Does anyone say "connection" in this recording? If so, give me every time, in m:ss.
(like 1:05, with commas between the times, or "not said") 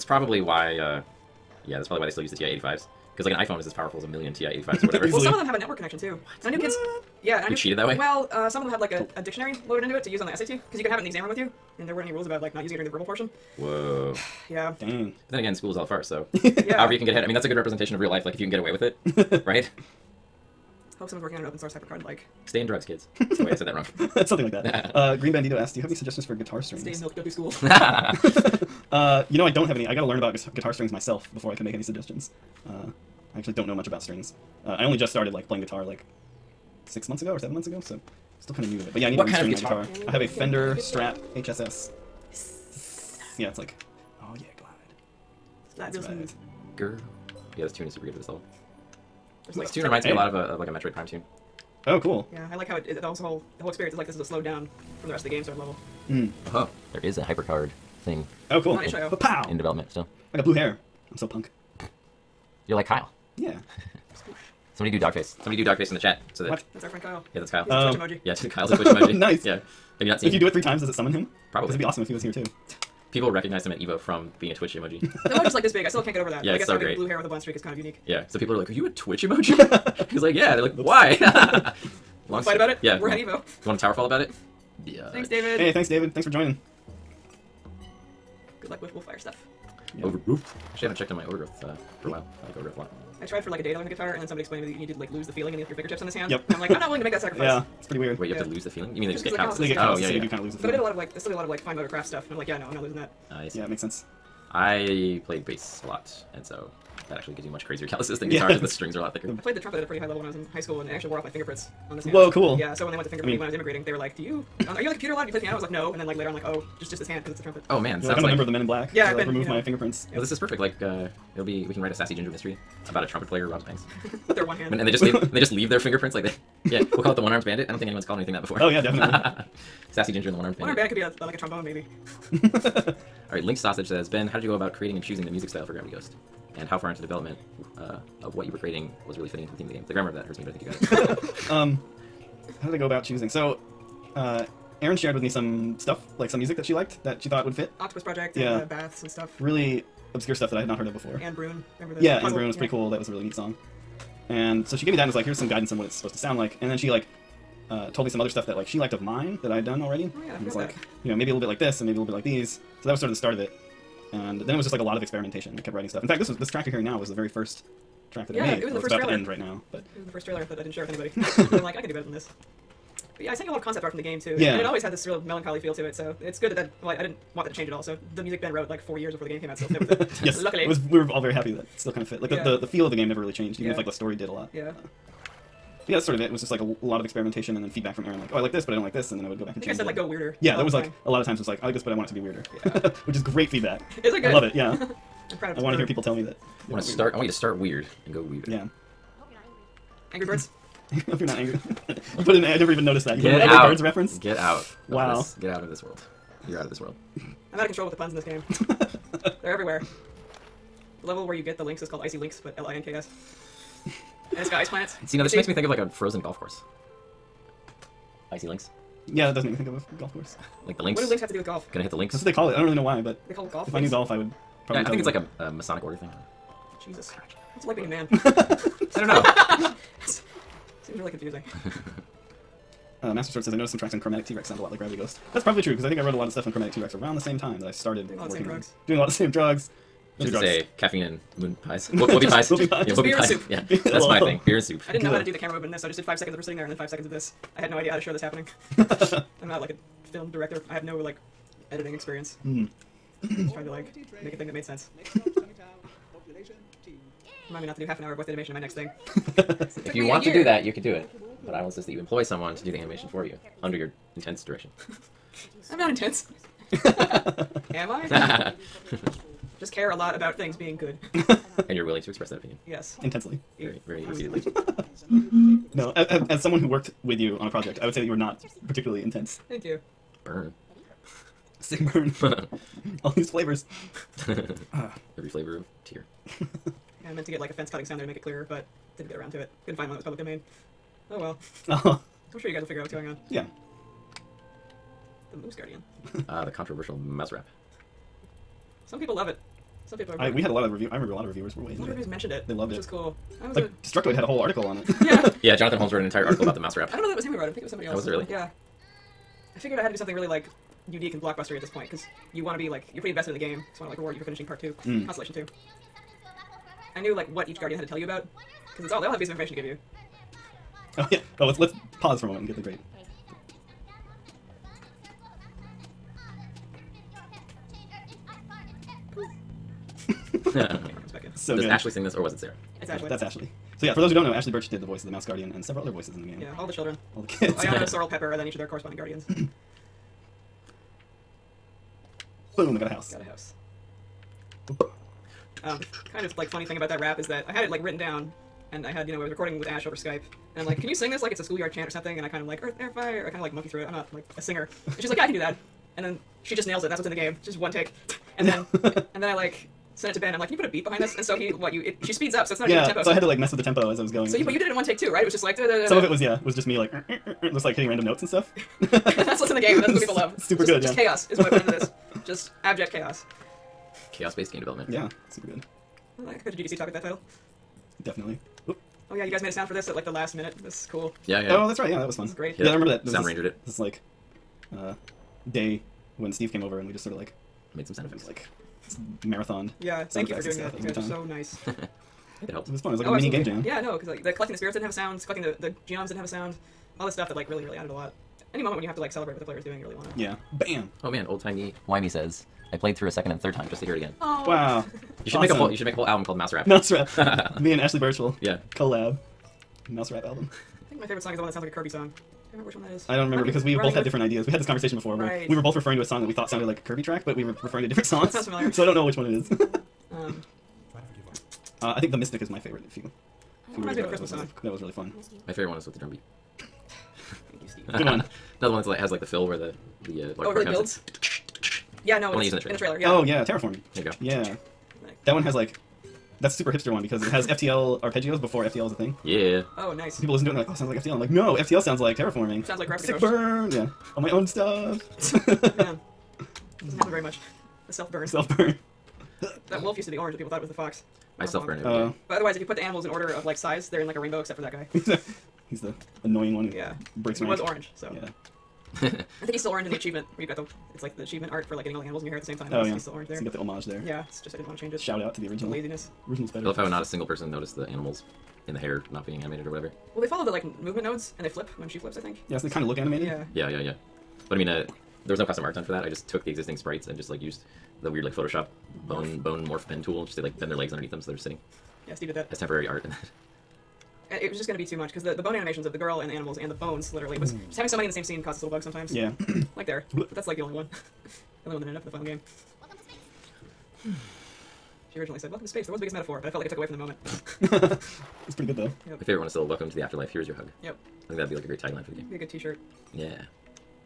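0:05.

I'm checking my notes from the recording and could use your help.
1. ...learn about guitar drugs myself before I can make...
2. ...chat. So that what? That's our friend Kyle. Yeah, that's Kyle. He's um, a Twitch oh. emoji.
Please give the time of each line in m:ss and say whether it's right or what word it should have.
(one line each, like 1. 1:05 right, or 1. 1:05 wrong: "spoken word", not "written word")
1. 0:30 wrong: "strings", not "drugs"
2. 1:05 right.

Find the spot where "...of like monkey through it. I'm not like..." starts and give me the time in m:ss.
5:53.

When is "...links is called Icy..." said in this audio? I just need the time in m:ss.
3:31.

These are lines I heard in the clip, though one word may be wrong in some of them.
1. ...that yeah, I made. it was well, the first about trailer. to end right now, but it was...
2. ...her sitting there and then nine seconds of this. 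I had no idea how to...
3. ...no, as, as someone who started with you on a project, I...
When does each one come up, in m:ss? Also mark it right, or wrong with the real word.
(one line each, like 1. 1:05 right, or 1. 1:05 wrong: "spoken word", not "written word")
1. 2:48 right
2. 4:06 wrong: "five", not "nine"
3. 4:35 wrong: "worked", not "started".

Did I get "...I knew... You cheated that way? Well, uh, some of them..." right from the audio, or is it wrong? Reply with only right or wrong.
right.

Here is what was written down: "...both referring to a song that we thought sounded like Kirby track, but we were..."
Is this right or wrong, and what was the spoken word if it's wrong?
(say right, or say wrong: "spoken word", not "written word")
right.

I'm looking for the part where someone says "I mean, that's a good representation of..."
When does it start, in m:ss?
0:17.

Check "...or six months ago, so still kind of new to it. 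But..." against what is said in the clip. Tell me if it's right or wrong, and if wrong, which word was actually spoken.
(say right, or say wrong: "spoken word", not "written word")
wrong: "seven", not "six".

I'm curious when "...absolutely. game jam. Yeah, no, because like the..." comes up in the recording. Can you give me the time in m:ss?
6:33.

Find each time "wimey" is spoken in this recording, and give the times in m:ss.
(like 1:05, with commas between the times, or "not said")
6:41.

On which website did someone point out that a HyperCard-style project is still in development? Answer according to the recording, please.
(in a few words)
itch.io.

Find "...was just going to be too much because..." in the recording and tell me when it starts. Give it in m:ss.
8:04.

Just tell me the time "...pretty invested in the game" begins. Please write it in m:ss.
5:13.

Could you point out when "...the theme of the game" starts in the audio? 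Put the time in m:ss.
2:19.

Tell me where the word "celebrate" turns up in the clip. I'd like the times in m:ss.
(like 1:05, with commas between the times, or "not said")
6:39.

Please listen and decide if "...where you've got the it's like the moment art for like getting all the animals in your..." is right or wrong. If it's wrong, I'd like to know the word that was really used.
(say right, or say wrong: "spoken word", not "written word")
wrong: "achievement", not "moment".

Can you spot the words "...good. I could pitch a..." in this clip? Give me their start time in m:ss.
6:15.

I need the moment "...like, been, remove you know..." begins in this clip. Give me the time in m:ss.
1:59.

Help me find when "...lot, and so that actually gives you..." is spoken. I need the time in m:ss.
1:45.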